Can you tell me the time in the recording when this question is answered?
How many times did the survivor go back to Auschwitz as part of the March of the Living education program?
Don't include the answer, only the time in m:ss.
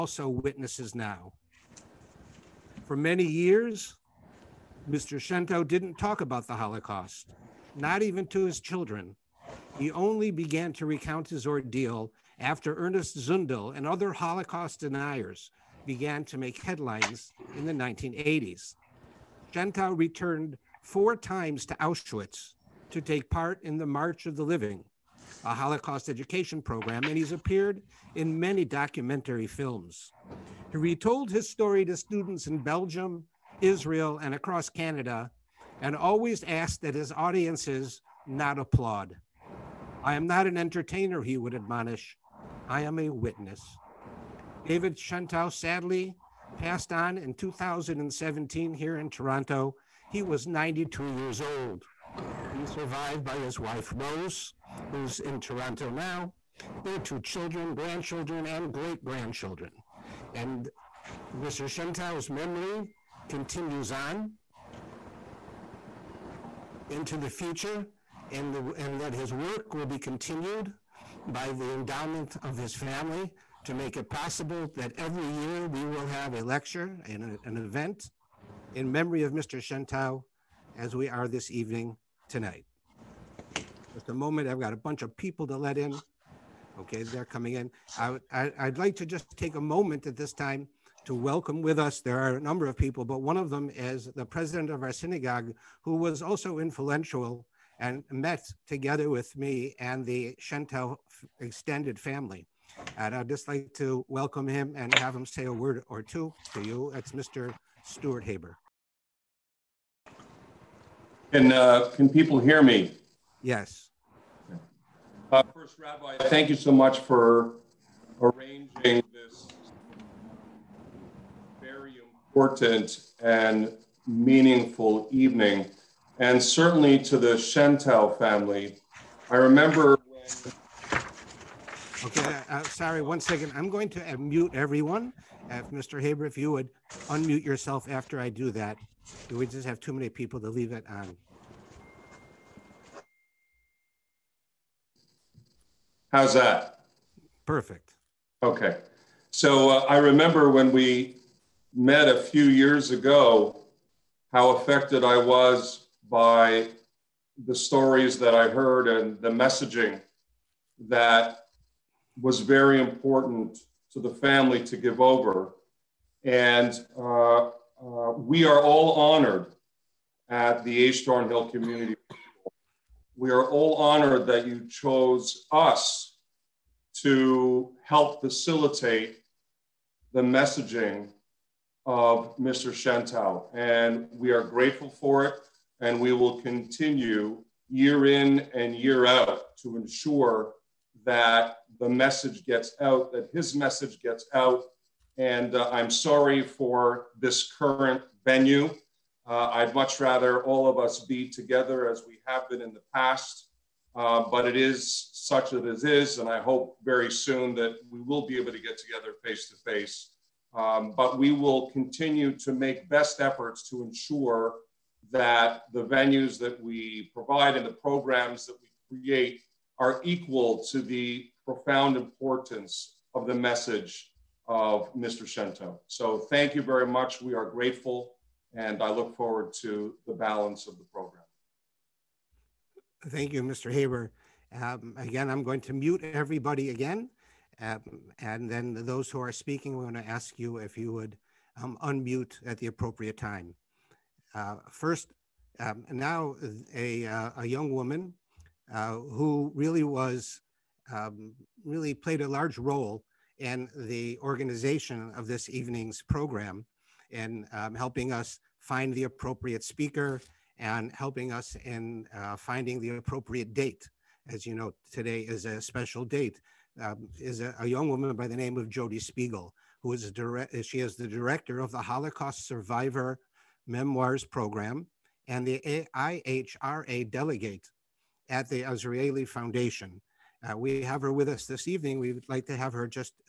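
0:20.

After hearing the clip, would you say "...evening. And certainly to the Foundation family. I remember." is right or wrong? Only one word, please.
wrong.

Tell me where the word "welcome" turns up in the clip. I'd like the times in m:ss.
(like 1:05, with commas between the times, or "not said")
1:31, 1:44.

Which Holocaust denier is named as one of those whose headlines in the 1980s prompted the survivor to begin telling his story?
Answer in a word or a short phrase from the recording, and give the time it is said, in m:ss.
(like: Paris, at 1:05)
Ernest Zundel, at 0:12.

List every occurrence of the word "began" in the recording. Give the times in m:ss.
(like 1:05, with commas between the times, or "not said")
0:10, 0:15.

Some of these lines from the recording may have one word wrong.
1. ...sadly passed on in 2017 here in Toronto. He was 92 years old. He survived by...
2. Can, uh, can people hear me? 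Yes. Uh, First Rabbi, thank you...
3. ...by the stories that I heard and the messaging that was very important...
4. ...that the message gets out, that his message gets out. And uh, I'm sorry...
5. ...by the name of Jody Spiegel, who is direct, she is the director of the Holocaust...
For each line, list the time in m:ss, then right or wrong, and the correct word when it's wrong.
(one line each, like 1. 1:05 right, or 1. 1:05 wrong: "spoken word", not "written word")
1. 0:45 right
2. 1:51 right
3. 2:36 right
4. 3:11 right
5. 4:28 right.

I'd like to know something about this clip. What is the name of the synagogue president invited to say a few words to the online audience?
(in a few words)
Stuart Haber.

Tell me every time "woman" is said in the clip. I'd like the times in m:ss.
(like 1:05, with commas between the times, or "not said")
4:07, 4:27.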